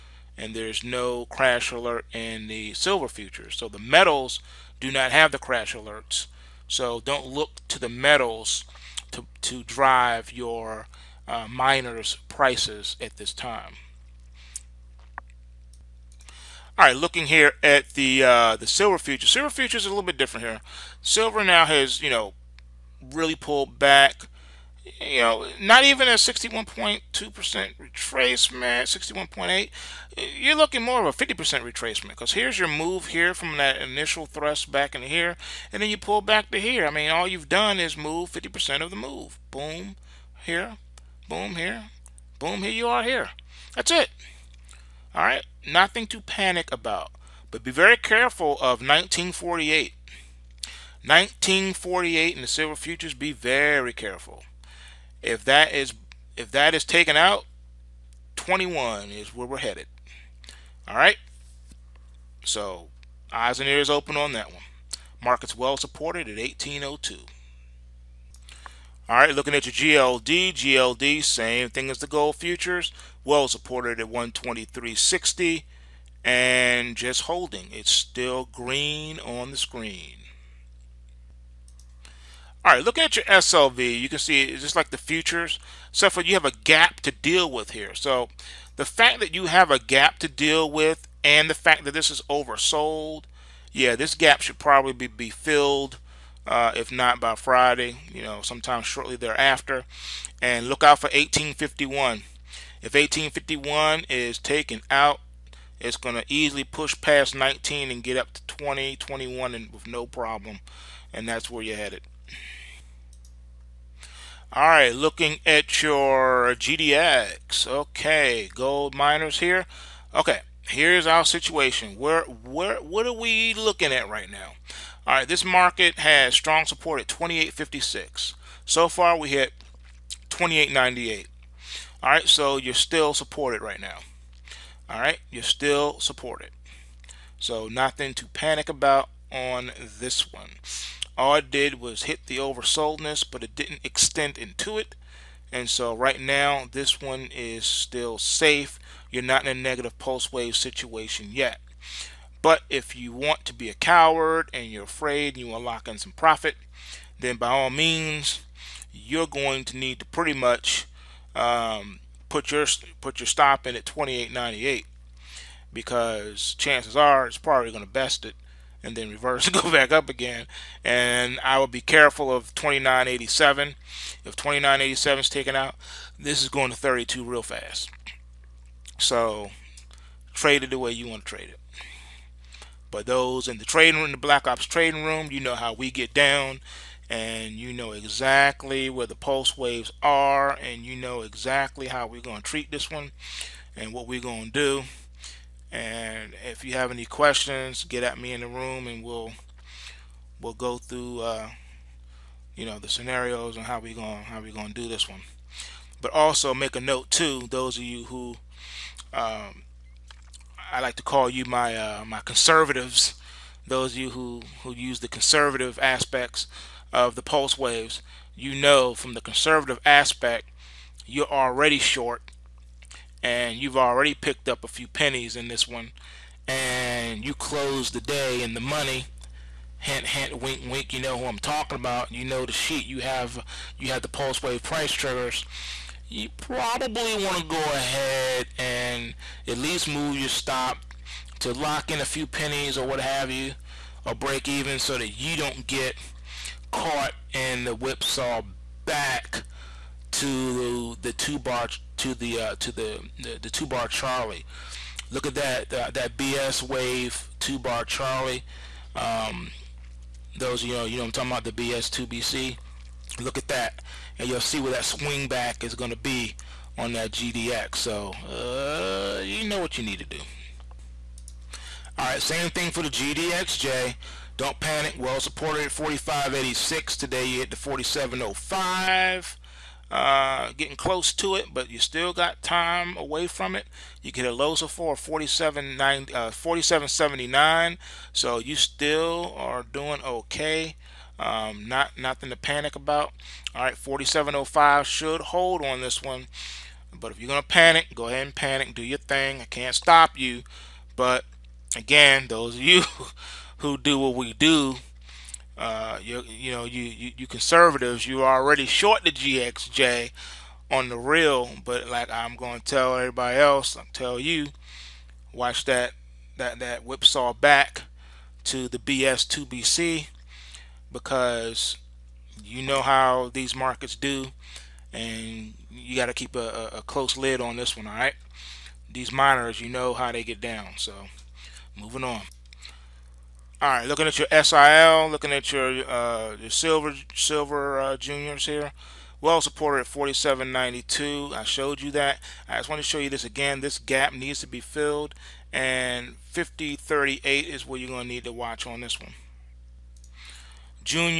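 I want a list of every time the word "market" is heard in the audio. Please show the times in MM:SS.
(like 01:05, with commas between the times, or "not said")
01:05, 02:05, 05:23.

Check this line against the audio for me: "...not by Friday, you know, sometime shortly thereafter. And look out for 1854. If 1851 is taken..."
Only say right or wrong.
wrong.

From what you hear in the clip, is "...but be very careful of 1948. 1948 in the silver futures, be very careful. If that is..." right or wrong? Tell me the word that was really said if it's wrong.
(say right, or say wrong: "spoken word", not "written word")
right.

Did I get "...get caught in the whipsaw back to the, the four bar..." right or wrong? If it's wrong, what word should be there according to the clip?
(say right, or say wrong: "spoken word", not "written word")
wrong: "two", not "four".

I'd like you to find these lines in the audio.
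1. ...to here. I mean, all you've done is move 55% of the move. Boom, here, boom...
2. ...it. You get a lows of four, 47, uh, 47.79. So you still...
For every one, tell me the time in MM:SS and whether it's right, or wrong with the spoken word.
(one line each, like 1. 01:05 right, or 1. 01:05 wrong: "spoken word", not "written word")
1. 00:36 wrong: "50", not "55"
2. 04:43 right.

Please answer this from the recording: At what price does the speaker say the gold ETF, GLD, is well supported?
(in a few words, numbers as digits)
123.60.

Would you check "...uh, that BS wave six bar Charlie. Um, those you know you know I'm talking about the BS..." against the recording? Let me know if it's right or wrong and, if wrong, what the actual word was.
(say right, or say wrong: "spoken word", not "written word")
wrong: "two", not "six".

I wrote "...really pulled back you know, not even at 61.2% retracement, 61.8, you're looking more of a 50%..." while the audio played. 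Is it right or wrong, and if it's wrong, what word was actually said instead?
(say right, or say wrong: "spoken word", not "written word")
right.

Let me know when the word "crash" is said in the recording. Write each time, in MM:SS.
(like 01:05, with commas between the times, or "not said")
00:01, 00:05.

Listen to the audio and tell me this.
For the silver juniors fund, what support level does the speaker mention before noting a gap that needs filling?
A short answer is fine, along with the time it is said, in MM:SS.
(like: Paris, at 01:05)
47.92, at 05:39.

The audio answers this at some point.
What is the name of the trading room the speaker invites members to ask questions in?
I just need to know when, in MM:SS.
03:04.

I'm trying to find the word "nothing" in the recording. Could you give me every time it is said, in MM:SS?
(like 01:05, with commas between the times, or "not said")
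00:45, 02:17, 04:51.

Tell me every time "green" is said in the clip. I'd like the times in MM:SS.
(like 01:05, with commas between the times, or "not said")
01:18.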